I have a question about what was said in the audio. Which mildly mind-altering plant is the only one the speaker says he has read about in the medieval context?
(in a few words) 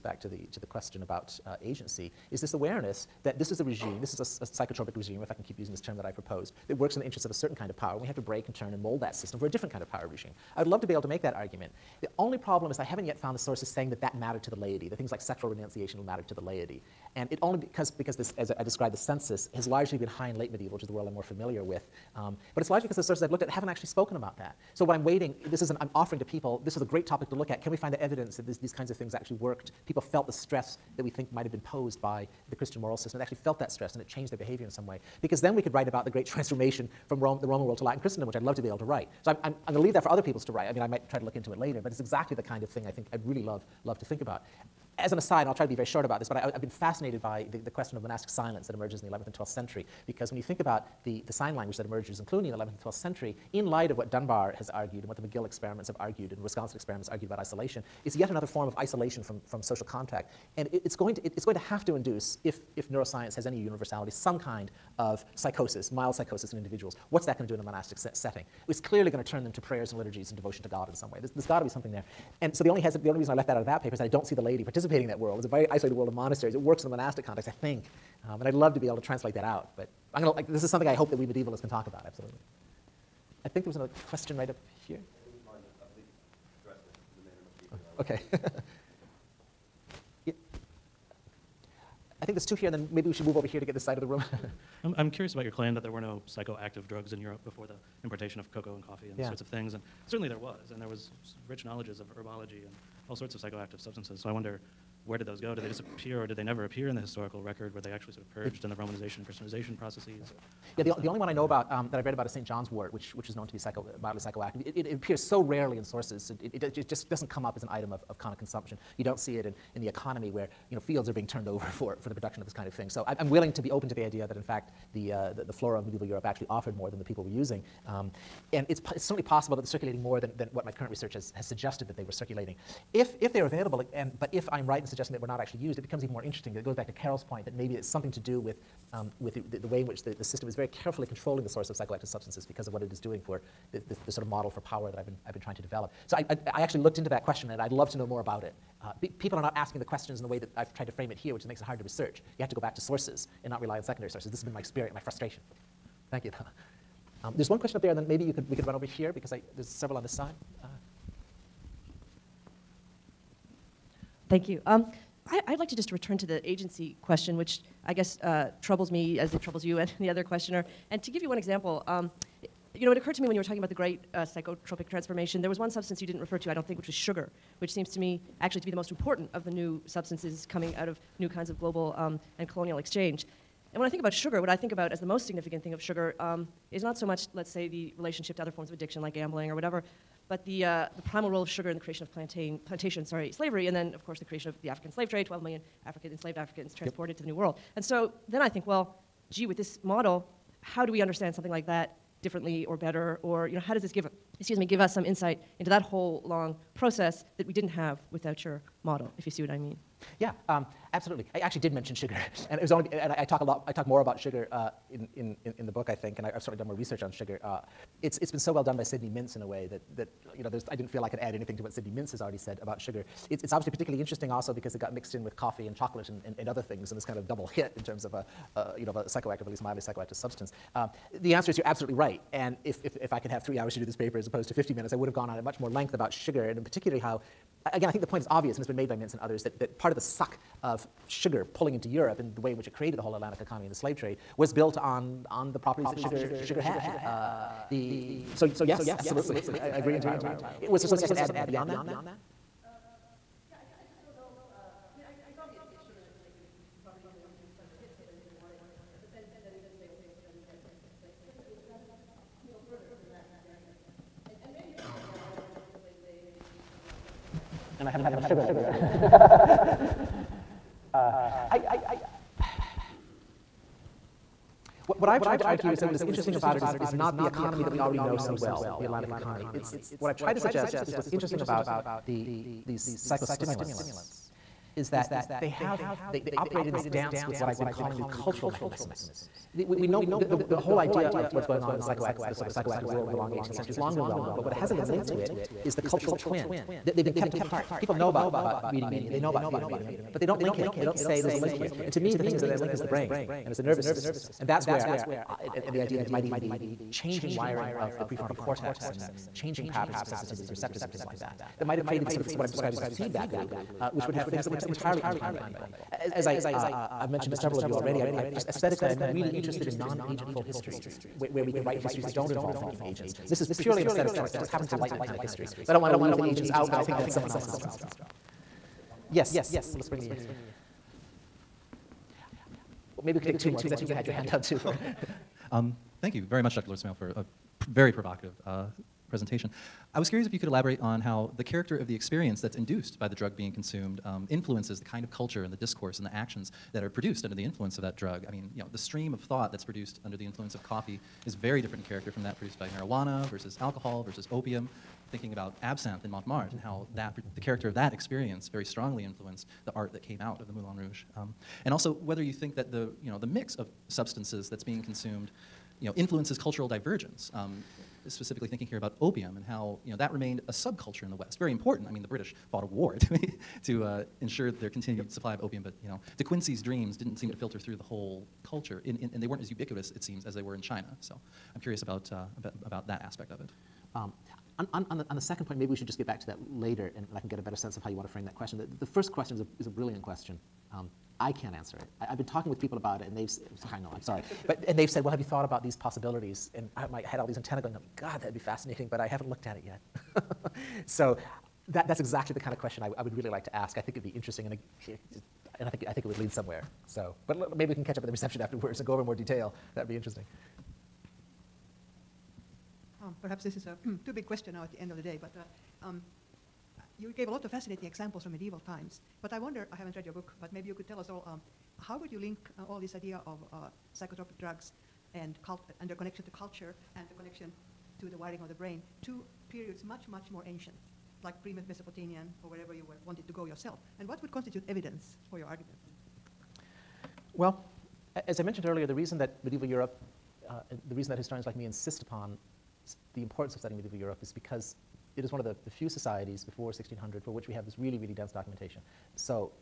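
St. John's wort.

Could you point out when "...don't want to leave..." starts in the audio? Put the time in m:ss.
5:25.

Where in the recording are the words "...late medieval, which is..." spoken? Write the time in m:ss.
0:20.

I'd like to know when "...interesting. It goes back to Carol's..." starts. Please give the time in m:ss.
2:16.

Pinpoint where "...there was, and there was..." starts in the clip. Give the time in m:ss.
1:40.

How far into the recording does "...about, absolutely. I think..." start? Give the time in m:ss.
1:21.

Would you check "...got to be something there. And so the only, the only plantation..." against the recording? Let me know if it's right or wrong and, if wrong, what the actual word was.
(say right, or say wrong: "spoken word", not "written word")
wrong: "reason", not "plantation".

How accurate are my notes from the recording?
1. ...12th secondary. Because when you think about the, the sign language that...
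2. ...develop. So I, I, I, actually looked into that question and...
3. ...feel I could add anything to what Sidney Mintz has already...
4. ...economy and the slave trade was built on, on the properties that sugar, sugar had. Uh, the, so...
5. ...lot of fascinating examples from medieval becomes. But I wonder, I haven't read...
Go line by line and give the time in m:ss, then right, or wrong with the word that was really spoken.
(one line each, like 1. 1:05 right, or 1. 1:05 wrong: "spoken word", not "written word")
1. 0:49 wrong: "century", not "secondary"
2. 2:25 right
3. 3:40 right
4. 4:03 right
5. 6:57 wrong: "times", not "becomes".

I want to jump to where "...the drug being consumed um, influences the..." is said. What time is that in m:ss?
5:43.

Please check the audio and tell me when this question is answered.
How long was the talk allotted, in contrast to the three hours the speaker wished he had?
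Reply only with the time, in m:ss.
3:54.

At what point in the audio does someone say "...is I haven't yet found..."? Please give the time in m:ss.
0:12.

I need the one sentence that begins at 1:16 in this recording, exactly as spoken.
It works in a monastic context, I think.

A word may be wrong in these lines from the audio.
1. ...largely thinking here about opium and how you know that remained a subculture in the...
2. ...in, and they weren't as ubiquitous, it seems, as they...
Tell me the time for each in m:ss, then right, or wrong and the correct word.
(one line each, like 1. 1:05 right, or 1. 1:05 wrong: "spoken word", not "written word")
1. 6:08 wrong: "specifically", not "largely"
2. 6:18 right.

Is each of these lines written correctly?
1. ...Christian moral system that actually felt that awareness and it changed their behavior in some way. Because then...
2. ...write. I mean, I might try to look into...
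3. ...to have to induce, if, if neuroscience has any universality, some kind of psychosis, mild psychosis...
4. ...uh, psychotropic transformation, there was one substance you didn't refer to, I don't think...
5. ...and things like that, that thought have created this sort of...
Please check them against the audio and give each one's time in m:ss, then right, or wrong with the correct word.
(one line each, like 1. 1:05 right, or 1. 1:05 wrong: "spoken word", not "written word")
1. 0:32 wrong: "stress", not "awareness"
2. 0:40 right
3. 1:01 right
4. 2:54 right
5. 5:10 wrong: "might", not "thought".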